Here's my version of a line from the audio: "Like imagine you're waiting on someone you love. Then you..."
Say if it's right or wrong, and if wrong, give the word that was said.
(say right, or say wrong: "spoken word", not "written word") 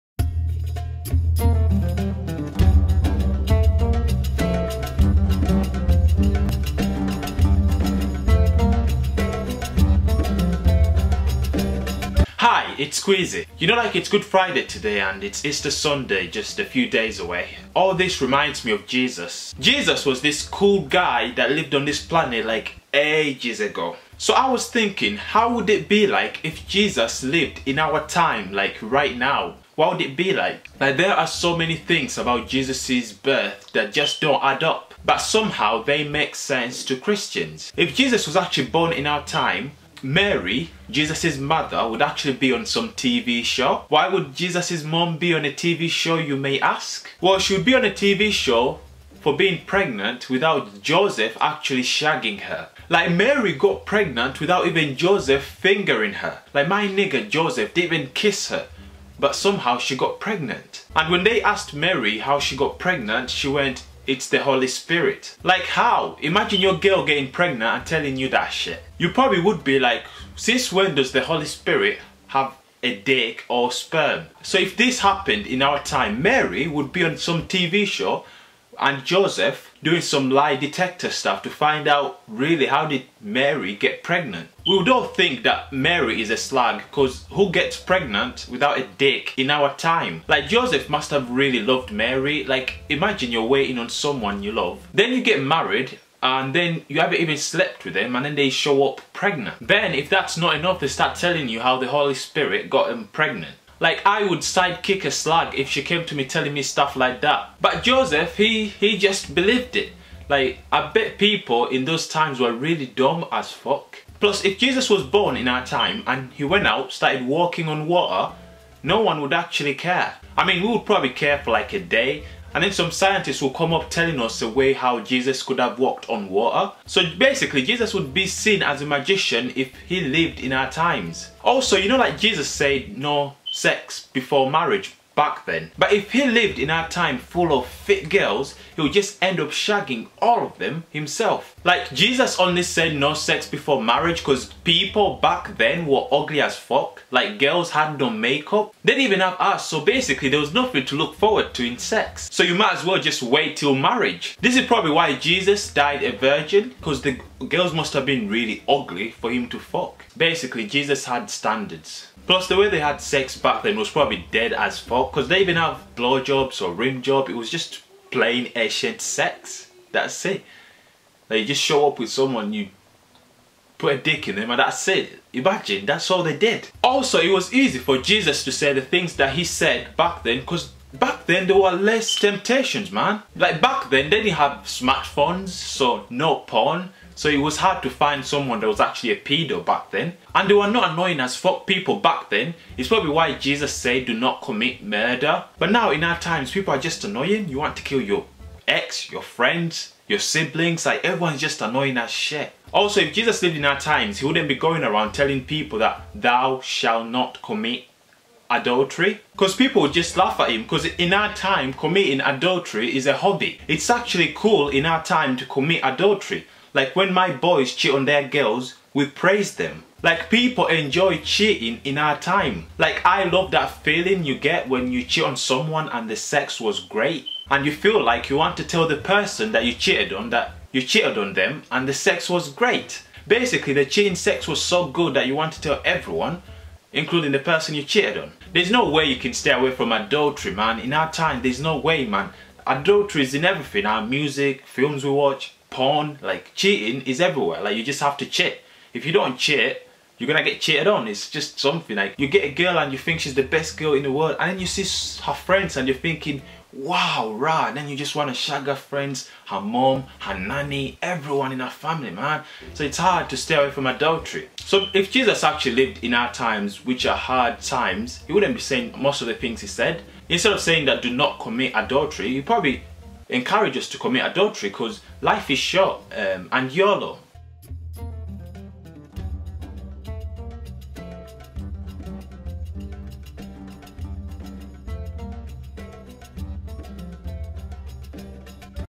right.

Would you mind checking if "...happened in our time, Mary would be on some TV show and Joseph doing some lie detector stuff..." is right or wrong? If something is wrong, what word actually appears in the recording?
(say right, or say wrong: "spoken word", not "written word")
right.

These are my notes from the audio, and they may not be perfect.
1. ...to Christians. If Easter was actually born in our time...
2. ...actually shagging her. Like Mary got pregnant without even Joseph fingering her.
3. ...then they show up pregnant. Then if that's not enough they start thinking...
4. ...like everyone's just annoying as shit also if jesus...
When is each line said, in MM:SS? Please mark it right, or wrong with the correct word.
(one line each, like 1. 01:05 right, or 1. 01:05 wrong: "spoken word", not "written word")
1. 00:36 wrong: "Jesus", not "Easter"
2. 00:51 right
3. 01:38 wrong: "telling", not "thinking"
4. 03:20 right.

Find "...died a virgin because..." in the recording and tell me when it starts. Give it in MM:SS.
02:35.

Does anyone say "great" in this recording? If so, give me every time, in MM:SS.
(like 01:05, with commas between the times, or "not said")
03:46, 03:52.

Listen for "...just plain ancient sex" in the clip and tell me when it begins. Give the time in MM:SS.
02:47.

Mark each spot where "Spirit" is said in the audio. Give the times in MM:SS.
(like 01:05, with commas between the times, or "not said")
01:04, 01:11, 01:42.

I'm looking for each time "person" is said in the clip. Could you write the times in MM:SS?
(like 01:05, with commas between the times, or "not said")
03:48, 03:57.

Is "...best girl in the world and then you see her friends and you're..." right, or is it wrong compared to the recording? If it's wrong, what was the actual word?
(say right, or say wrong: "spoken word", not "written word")
right.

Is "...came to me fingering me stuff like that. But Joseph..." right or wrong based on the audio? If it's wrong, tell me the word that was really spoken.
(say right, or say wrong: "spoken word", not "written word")
wrong: "telling", not "fingering".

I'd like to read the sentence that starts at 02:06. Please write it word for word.
So basically, Jesus would be seen as a magician if he lived in our times.